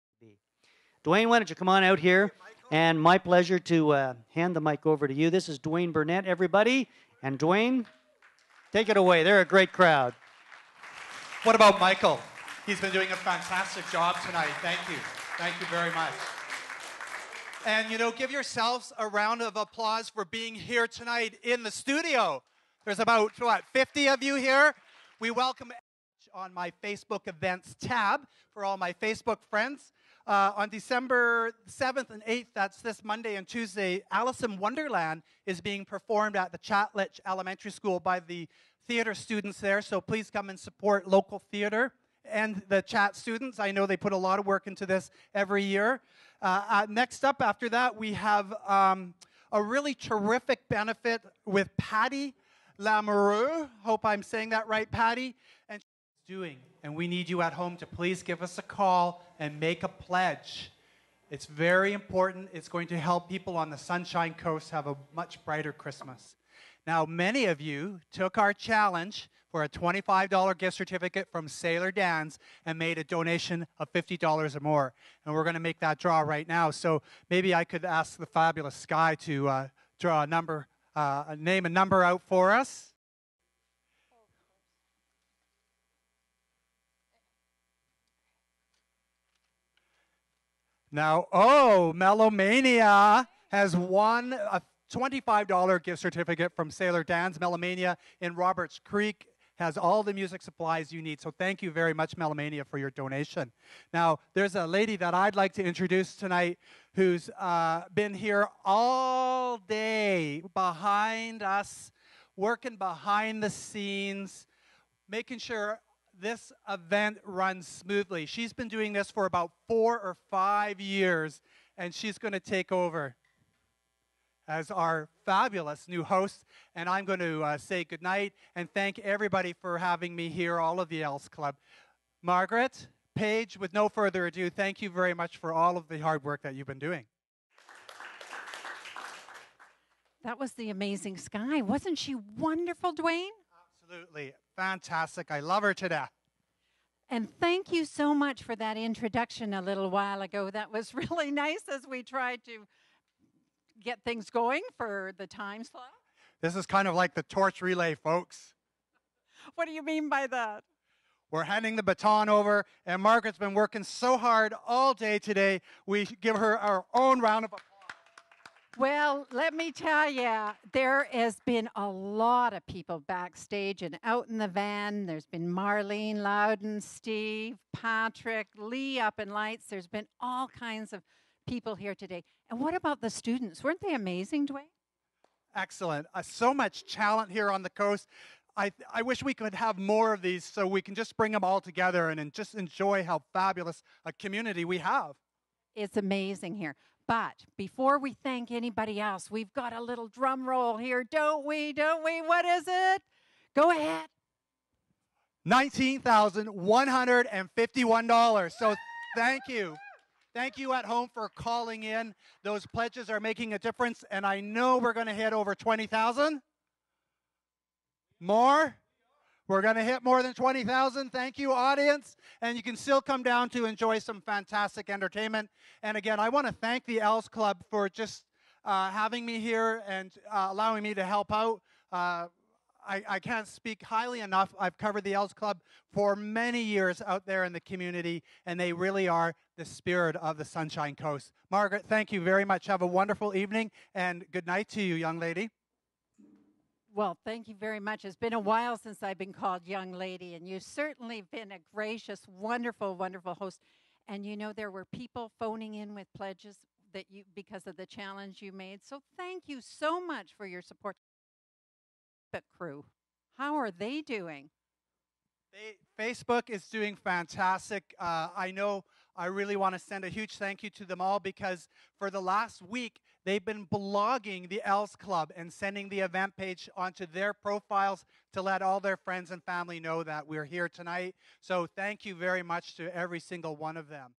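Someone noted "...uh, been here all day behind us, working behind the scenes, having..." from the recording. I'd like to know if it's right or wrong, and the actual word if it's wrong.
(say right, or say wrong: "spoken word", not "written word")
wrong: "making", not "having".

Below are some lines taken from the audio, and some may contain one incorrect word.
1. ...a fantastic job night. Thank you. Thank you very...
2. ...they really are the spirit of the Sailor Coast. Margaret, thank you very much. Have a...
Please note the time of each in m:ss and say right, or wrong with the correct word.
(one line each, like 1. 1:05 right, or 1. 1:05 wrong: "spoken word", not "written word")
1. 0:13 wrong: "tonight", not "night"
2. 3:58 wrong: "Sunshine", not "Sailor".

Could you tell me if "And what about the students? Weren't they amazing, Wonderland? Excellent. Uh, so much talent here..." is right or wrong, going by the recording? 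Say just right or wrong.
wrong.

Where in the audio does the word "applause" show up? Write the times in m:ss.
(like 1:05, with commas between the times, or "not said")
0:19, 2:47.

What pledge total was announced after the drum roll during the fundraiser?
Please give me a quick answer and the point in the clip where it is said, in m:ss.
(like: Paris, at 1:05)
$19,151, at 3:25.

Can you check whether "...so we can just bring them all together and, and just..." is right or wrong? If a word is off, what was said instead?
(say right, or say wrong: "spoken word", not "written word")
right.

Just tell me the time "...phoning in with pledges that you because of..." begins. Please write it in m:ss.
4:15.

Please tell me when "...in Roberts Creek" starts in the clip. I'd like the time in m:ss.
1:38.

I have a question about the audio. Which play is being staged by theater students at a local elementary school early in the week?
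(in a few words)
Alice in Wonderland.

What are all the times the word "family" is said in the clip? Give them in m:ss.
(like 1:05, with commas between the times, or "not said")
4:39.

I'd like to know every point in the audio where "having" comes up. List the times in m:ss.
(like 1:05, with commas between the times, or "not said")
2:09, 3:48.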